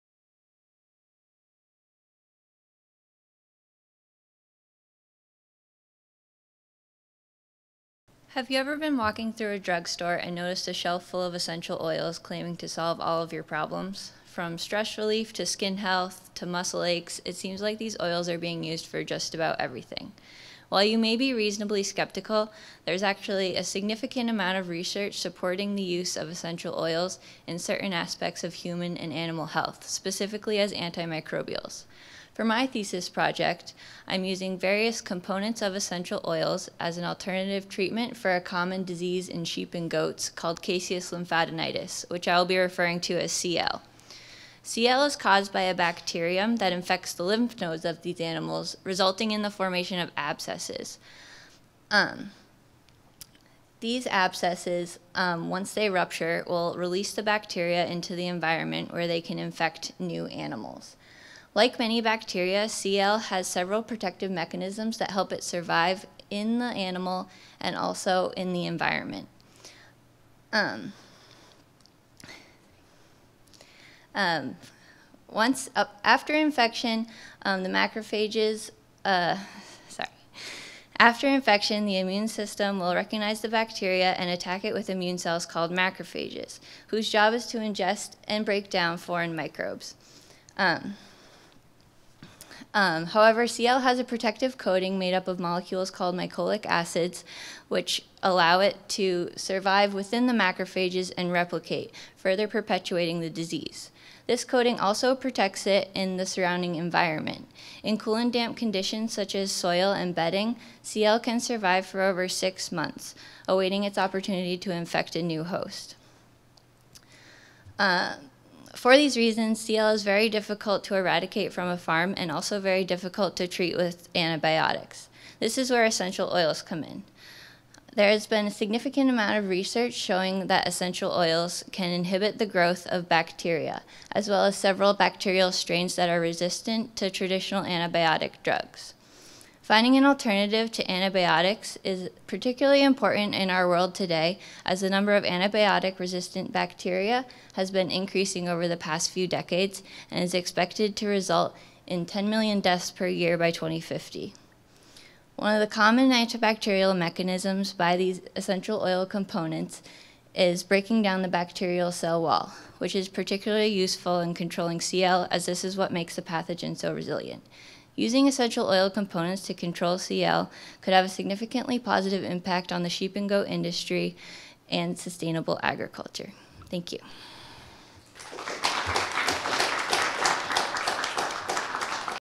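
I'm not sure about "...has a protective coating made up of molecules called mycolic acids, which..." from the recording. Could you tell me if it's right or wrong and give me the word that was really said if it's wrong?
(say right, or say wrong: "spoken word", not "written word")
right.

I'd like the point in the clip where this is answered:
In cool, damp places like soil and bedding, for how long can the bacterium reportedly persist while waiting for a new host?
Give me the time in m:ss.
1:52.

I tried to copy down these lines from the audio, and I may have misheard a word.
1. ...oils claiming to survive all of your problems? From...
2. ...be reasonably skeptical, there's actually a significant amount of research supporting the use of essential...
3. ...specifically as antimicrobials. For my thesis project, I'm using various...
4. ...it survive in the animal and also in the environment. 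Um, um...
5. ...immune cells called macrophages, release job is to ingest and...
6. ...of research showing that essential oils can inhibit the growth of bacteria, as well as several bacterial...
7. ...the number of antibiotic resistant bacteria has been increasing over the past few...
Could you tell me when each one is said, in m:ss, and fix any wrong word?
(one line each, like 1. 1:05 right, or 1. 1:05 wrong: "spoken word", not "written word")
1. 0:11 wrong: "solve", not "survive"
2. 0:21 right
3. 0:29 right
4. 1:05 right
5. 1:24 wrong: "whose", not "release"
6. 2:09 right
7. 2:24 right.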